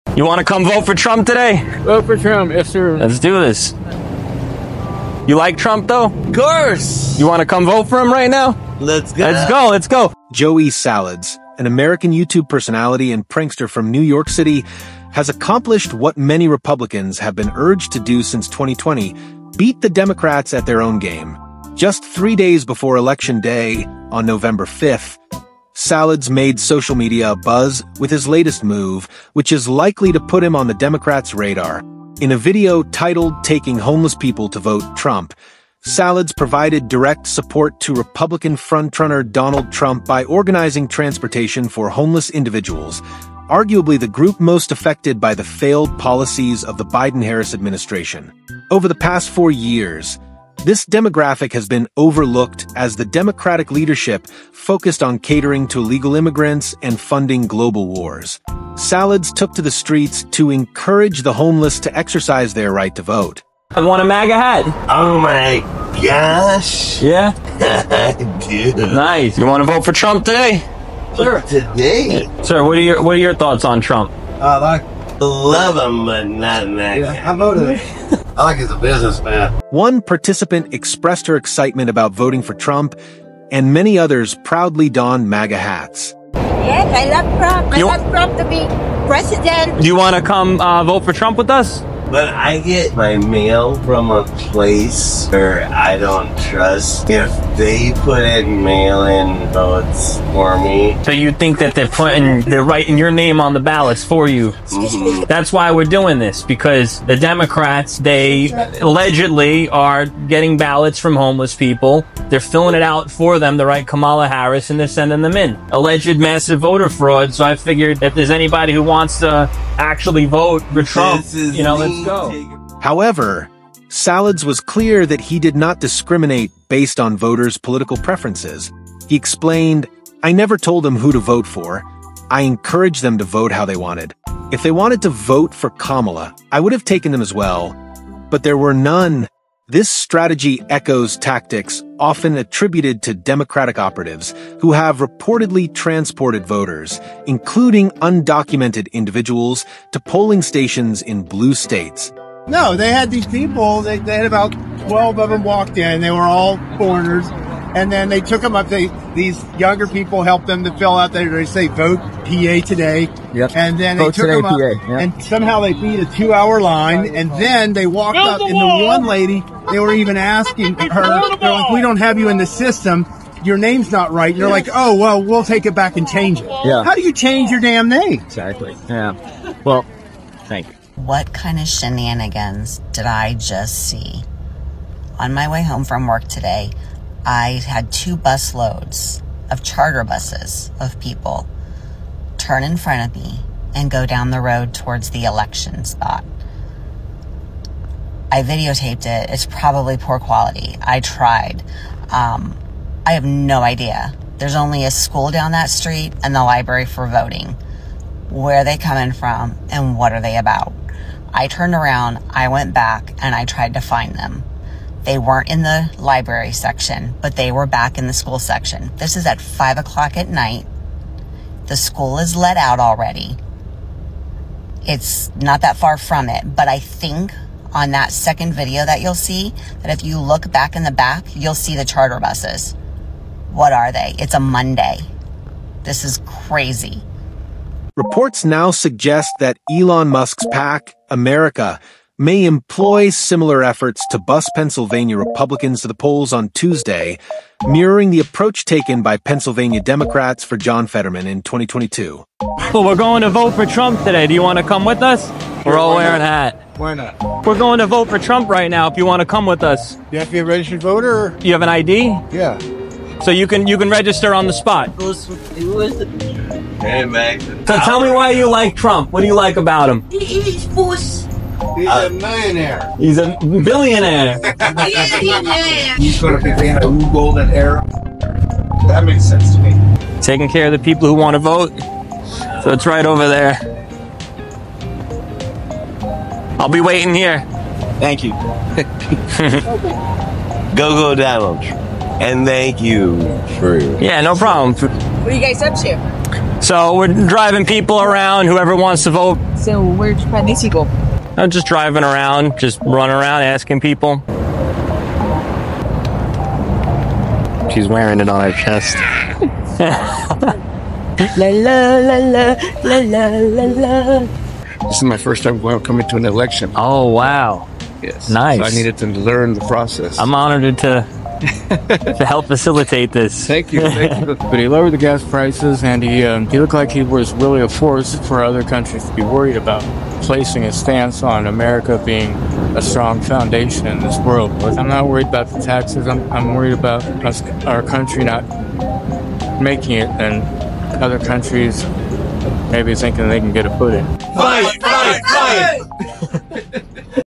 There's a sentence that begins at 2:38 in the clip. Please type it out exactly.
They these younger people helped them to fill out They say vote PA today.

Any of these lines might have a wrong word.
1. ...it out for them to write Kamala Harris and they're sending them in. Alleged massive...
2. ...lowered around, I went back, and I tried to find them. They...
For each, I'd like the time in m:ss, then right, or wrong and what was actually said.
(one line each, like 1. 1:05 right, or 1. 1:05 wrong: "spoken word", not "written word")
1. 1:52 right
2. 3:31 wrong: "turned", not "lowered".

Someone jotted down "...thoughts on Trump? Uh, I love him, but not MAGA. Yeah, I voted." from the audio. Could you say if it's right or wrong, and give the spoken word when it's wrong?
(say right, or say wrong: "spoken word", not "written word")
right.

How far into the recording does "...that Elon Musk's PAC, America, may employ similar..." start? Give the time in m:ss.
3:59.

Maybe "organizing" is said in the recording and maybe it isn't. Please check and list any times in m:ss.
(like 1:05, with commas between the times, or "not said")
0:40.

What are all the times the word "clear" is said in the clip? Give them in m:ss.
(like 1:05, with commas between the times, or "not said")
2:04.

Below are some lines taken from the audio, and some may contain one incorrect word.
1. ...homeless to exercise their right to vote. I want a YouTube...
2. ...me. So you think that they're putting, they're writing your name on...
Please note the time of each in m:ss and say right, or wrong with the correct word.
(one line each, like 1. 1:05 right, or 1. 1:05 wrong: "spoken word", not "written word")
1. 1:01 wrong: "MAGA", not "YouTube"
2. 1:40 right.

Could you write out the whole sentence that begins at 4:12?
Well, we're going to vote for Trump today.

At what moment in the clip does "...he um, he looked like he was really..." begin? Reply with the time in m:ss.
5:26.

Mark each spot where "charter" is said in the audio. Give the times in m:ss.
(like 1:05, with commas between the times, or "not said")
3:09, 3:51.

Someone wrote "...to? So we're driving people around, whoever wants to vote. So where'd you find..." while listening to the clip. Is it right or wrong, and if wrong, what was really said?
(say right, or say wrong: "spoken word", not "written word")
right.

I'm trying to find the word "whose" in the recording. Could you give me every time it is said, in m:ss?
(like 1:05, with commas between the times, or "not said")
not said.